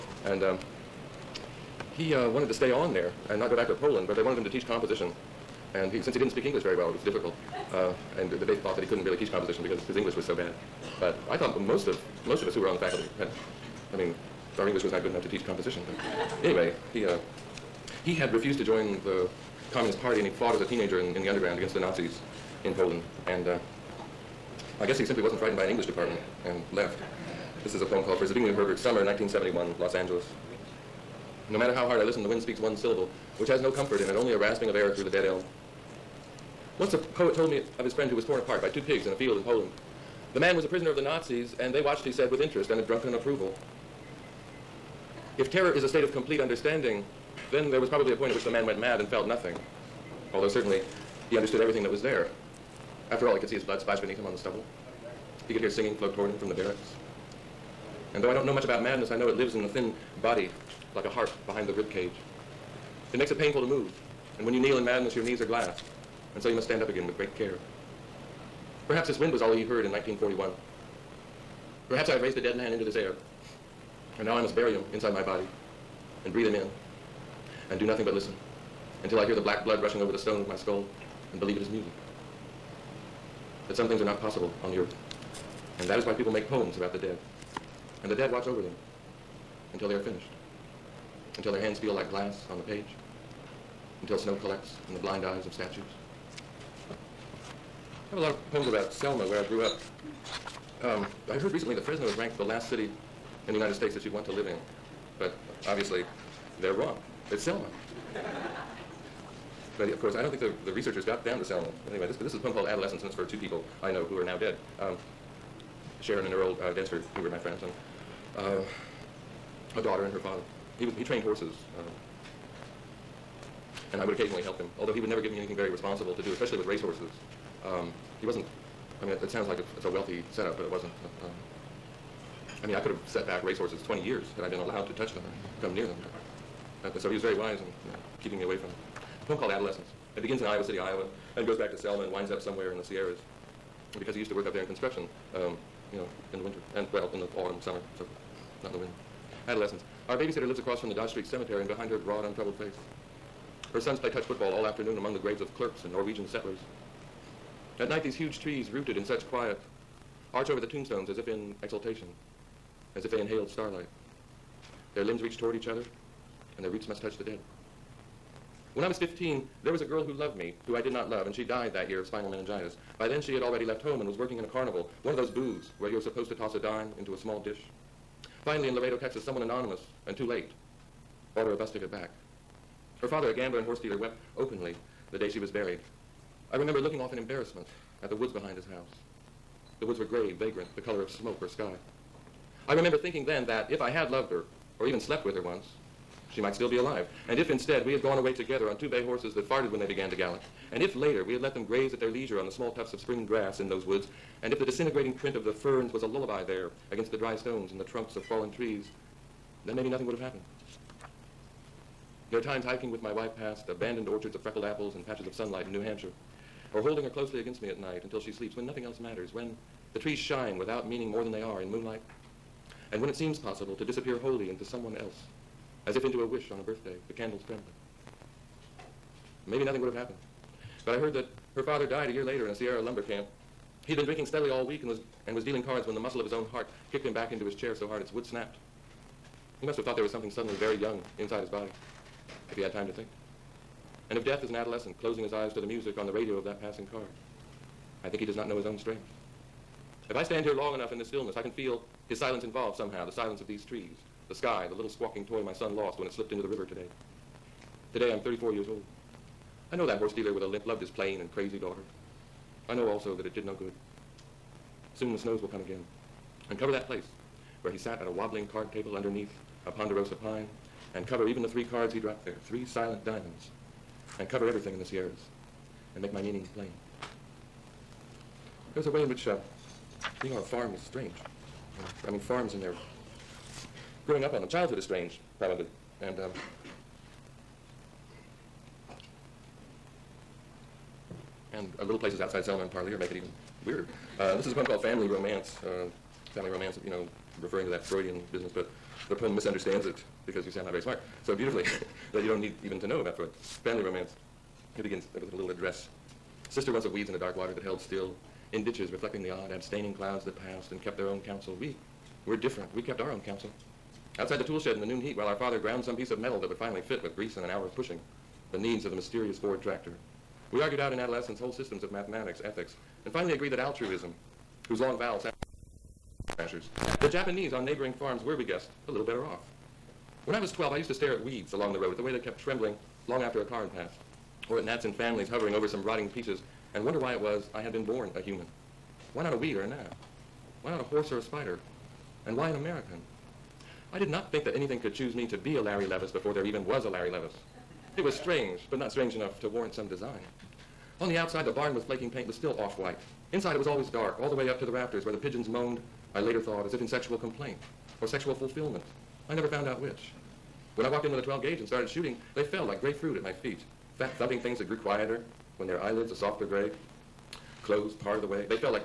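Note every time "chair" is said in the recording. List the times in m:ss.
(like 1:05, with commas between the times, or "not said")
3:57.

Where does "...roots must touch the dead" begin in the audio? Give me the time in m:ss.
2:46.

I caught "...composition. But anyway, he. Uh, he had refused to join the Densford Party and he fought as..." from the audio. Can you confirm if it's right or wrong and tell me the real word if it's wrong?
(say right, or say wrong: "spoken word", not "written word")
wrong: "Communist", not "Densford".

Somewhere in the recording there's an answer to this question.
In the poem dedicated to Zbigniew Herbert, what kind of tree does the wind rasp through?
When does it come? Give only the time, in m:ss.
0:35.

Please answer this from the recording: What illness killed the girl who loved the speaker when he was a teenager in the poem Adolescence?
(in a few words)
Spinal meningitis.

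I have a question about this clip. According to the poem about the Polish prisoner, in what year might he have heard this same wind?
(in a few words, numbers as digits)
1941.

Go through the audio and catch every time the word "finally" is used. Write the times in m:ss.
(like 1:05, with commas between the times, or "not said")
2:58, 5:16, 5:23.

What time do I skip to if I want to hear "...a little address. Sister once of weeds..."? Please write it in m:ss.
5:05.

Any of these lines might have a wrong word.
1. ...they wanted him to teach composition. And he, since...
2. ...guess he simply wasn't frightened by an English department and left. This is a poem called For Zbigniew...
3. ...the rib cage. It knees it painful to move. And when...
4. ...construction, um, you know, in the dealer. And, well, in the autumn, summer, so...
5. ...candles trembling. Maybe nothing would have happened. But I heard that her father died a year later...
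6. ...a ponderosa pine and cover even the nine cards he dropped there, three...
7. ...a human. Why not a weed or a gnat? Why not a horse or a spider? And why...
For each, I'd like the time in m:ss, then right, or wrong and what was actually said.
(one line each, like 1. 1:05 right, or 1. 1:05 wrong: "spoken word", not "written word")
1. 0:04 right
2. 0:24 right
3. 1:01 wrong: "makes", not "knees"
4. 2:24 wrong: "winter", not "dealer"
5. 3:47 right
6. 4:29 wrong: "three", not "nine"
7. 5:38 right.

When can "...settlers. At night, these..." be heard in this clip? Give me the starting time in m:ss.
2:36.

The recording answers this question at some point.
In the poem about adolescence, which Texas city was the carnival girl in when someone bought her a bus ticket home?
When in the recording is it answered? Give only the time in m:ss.
2:58.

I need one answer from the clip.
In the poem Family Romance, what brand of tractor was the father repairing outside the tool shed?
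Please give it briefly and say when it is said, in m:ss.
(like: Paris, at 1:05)
Ford, at 5:19.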